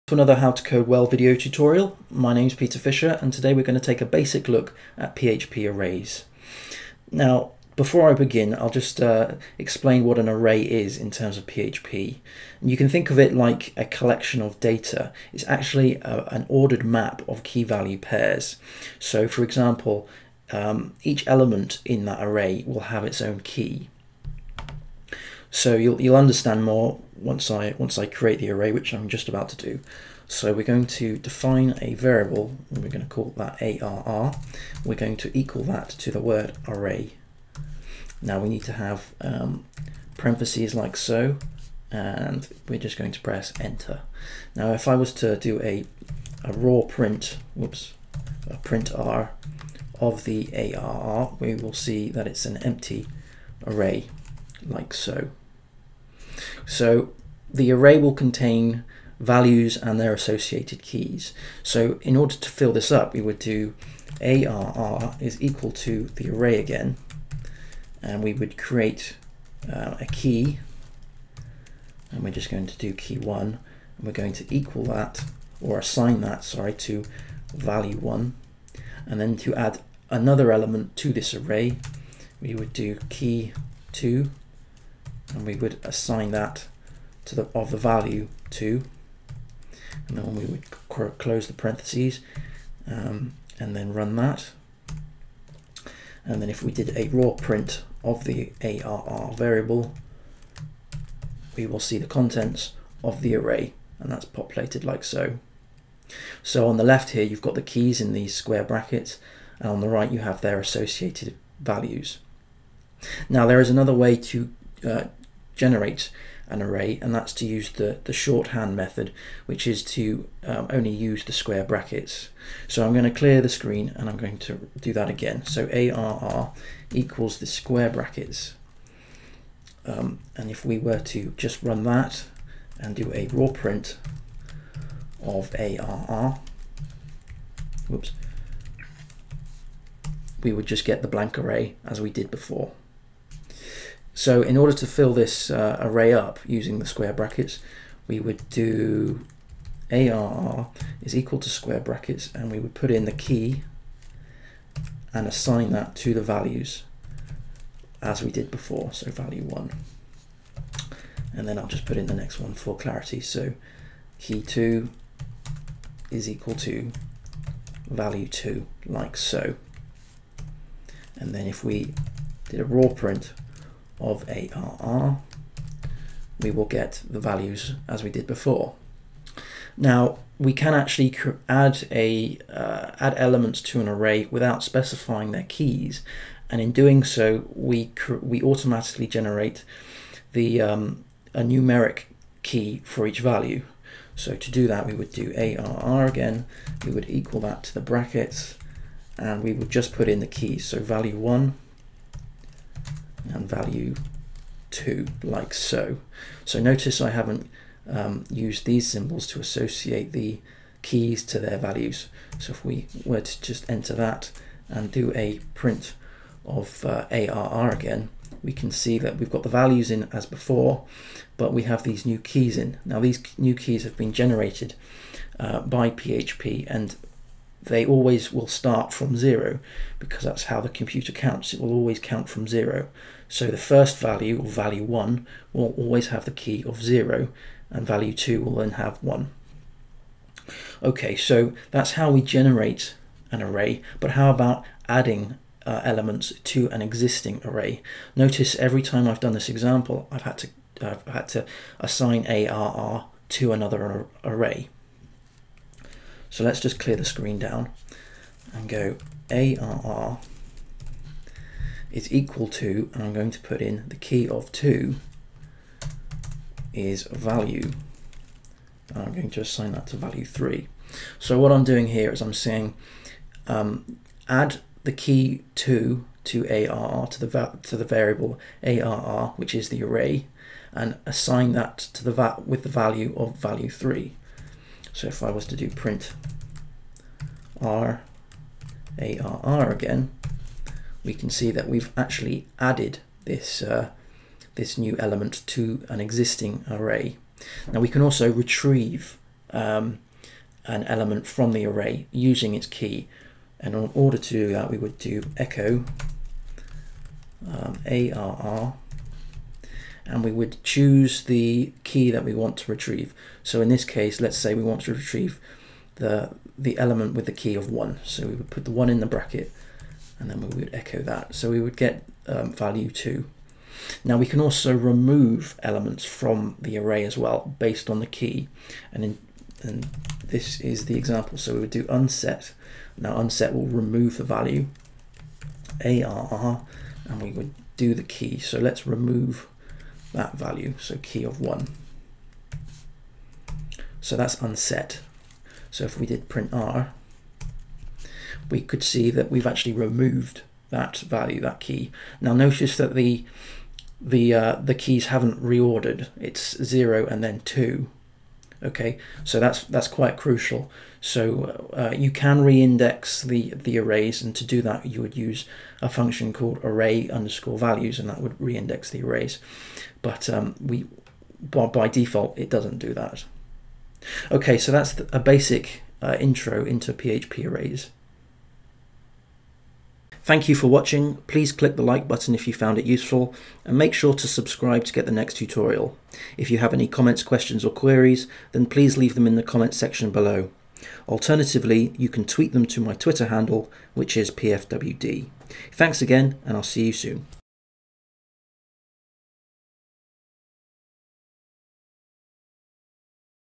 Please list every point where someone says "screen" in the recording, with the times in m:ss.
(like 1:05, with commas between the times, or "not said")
2:03, 4:17.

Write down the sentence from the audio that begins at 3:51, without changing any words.
It will always count from zero.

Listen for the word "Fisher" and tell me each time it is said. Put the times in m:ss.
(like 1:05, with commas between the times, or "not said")
0:02.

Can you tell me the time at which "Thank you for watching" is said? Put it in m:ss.
6:20.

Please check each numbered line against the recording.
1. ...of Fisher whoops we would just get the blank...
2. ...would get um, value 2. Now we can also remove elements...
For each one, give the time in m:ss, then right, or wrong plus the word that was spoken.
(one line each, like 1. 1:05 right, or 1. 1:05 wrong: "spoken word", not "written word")
1. 2:15 wrong: "ARR", not "Fisher"
2. 5:21 right.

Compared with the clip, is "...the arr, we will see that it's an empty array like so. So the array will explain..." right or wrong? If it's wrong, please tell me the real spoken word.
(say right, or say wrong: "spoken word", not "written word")
wrong: "contain", not "explain".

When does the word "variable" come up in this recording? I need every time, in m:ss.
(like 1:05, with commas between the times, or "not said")
0:31, 1:39, 4:37.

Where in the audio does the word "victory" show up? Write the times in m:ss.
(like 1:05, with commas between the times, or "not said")
not said.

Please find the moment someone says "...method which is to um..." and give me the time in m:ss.
1:58.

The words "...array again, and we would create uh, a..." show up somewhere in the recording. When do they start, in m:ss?
1:06.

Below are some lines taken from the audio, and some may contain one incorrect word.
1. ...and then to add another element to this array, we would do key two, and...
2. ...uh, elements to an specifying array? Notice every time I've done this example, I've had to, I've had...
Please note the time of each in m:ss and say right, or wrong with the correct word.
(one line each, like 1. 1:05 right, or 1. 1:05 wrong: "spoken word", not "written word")
1. 1:19 right
2. 4:05 wrong: "existing", not "specifying".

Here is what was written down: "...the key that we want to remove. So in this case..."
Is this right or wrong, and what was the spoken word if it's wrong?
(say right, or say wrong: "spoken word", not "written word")
wrong: "retrieve", not "remove".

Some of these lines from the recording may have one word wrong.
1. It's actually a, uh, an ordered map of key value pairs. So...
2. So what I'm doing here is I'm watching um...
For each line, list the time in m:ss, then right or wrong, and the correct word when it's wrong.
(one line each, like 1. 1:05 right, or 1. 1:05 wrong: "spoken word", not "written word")
1. 0:15 right
2. 4:31 wrong: "saying", not "watching".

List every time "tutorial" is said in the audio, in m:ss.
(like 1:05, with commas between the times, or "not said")
0:01, 6:25.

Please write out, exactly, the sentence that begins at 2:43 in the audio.
So key 2 is equal to value 2, like so.